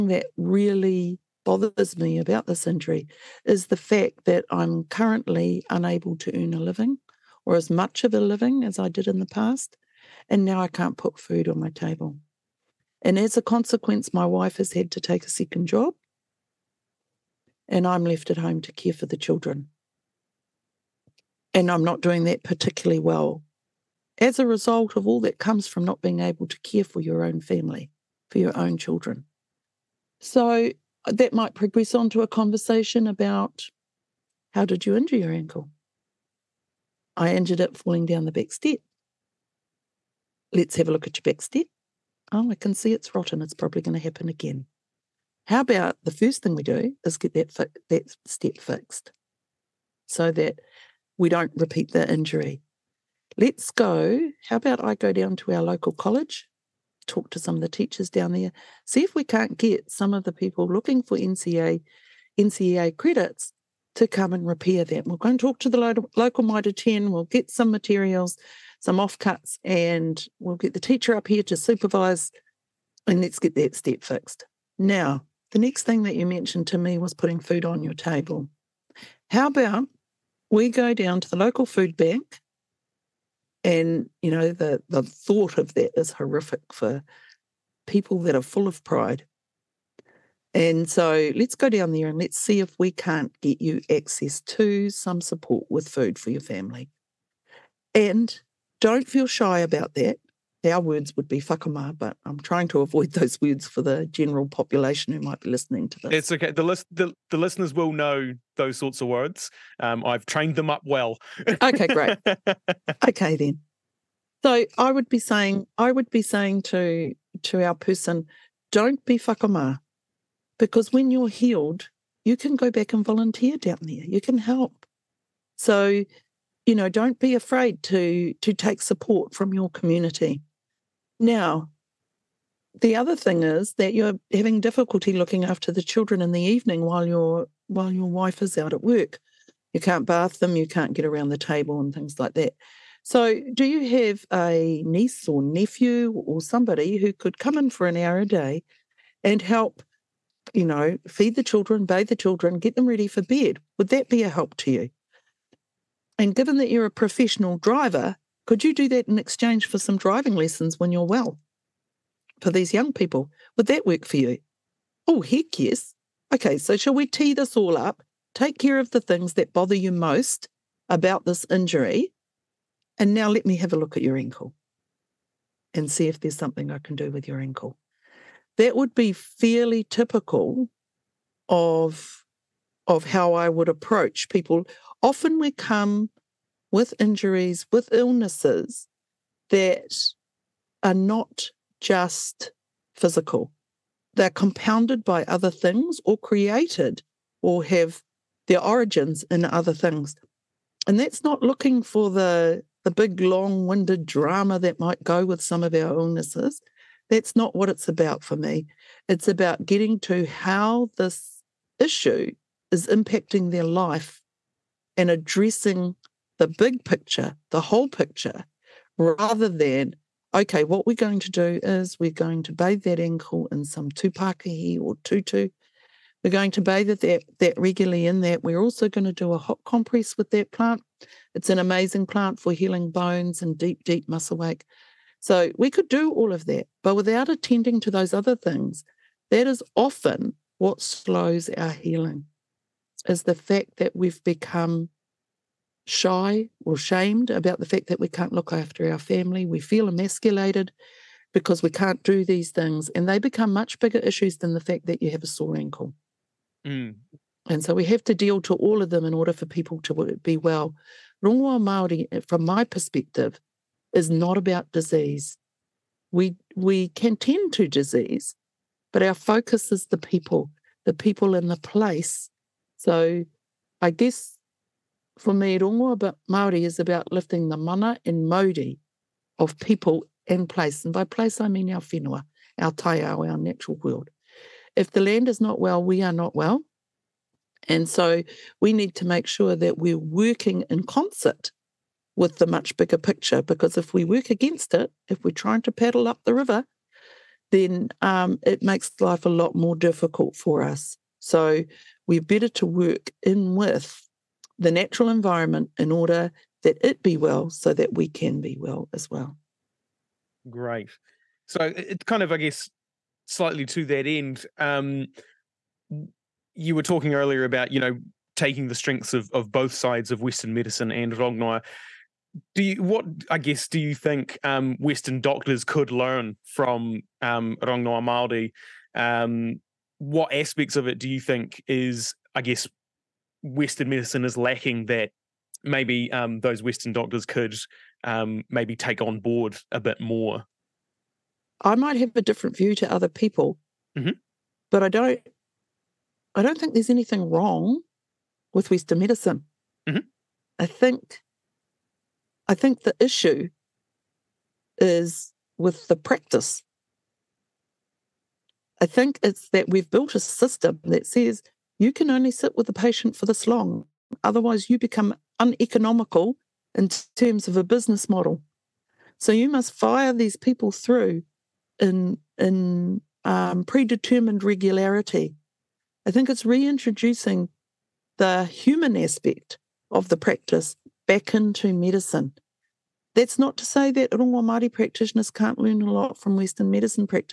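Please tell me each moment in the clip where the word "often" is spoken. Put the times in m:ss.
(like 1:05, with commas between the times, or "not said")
3:05, 3:59.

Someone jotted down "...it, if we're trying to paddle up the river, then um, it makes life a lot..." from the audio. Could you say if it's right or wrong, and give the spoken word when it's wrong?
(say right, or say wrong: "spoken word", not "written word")
right.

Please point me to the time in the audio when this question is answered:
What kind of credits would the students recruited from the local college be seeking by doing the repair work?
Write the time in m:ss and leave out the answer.
1:02.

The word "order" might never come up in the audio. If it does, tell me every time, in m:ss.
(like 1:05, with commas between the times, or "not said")
4:19, 5:05.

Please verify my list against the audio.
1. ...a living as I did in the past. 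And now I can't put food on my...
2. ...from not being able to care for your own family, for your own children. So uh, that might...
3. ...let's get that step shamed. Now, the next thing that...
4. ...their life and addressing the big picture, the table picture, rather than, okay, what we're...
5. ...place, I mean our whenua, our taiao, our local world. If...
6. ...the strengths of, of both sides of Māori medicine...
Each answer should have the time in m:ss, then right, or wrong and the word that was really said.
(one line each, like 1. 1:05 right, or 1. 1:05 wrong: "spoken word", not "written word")
1. 0:08 right
2. 0:25 right
3. 1:13 wrong: "fixed", not "shamed"
4. 3:33 wrong: "whole", not "table"
5. 4:41 wrong: "natural", not "local"
6. 5:18 wrong: "Western", not "Māori".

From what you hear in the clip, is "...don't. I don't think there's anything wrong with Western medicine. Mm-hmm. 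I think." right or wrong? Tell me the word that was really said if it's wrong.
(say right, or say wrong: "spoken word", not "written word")
right.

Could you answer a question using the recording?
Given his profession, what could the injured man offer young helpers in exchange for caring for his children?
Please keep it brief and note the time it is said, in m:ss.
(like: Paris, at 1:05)
driving lessons, at 2:39.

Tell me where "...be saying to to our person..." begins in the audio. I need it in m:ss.
1:56.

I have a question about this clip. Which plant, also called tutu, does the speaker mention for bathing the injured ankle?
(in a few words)
tūpākihi.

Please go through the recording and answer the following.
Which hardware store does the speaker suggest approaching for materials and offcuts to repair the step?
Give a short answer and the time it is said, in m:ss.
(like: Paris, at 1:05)
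Mitre 10, at 1:06.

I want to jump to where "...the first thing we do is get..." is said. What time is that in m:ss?
0:46.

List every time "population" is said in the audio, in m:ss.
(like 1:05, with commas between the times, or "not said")
1:44.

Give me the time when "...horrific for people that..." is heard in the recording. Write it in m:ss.
1:26.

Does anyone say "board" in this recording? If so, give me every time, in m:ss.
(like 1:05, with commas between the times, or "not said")
5:39.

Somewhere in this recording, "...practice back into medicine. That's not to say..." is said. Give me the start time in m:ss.
6:20.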